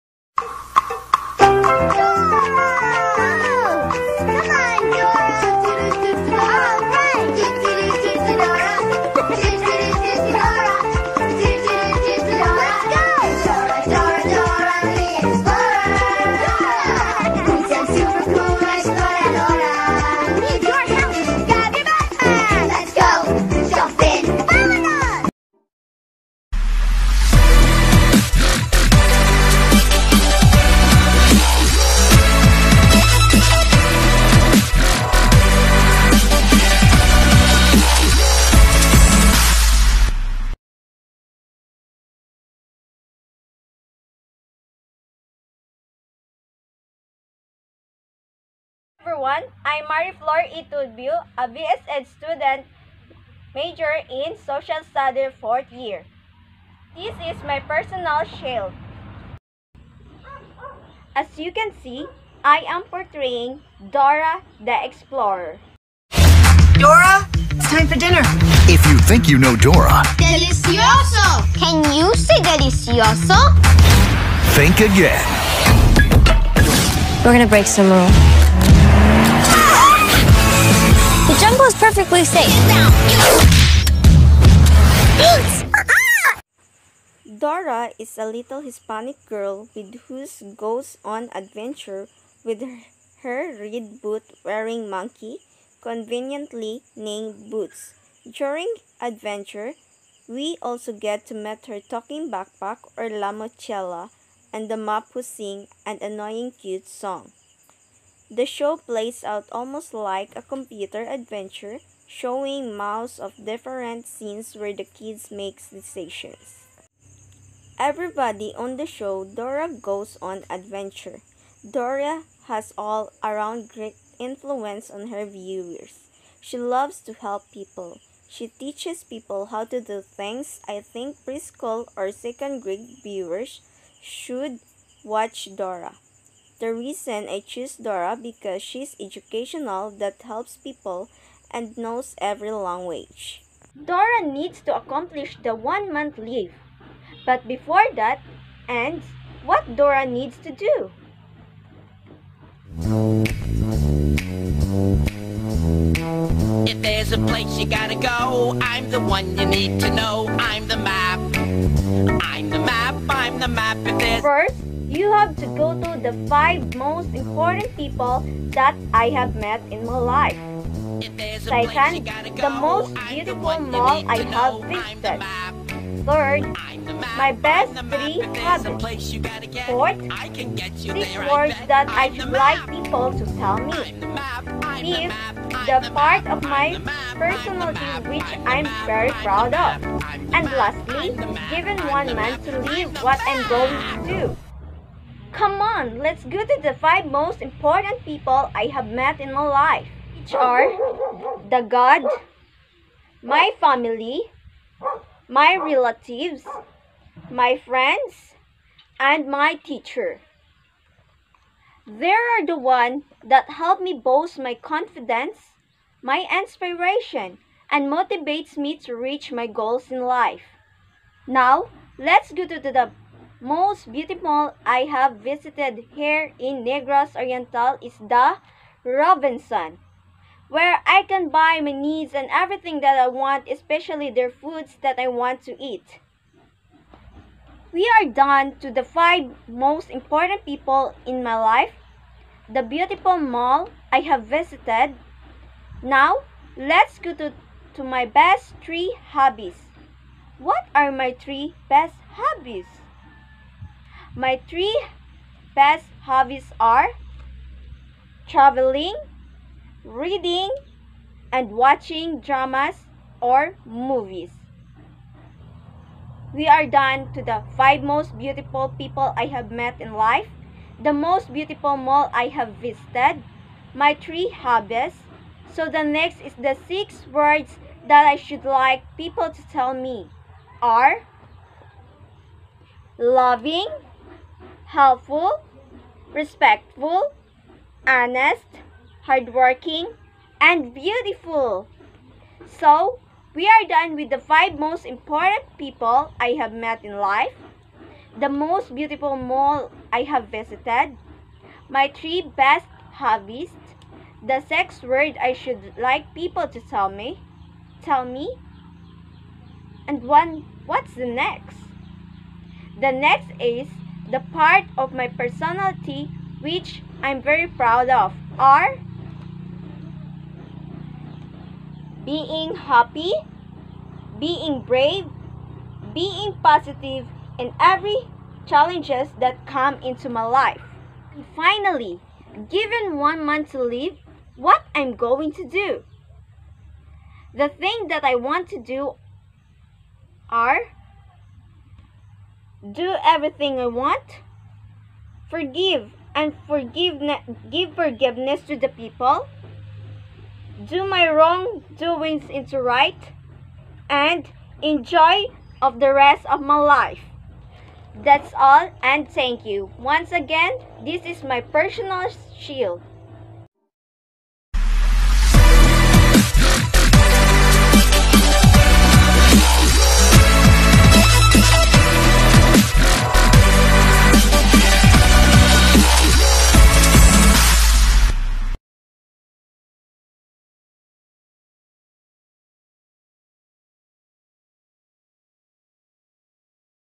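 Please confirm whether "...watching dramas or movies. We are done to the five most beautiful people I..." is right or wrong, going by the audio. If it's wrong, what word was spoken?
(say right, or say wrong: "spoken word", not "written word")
right.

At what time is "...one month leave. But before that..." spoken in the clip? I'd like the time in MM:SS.
02:25.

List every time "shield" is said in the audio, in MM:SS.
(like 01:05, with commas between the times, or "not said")
00:58, 06:02.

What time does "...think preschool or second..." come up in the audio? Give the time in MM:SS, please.
02:10.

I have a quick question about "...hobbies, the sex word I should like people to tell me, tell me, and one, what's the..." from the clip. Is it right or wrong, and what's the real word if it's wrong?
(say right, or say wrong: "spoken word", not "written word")
right.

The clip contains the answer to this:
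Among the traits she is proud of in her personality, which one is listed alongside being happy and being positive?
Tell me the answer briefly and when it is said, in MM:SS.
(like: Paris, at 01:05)
Being brave, at 05:24.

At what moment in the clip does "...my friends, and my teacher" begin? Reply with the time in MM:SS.
03:27.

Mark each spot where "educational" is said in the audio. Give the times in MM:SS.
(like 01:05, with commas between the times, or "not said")
02:19.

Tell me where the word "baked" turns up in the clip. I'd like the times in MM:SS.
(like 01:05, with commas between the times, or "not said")
not said.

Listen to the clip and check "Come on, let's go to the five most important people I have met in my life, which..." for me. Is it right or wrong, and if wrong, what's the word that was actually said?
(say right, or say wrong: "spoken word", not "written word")
right.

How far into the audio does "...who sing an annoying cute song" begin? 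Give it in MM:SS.
01:45.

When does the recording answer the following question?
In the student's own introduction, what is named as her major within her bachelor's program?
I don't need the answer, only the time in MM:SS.
00:54.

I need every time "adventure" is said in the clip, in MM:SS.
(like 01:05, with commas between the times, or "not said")
01:31, 01:38, 01:51, 02:00.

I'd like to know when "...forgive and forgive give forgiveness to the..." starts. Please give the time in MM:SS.
05:45.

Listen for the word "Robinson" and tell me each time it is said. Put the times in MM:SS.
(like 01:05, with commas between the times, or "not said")
03:48.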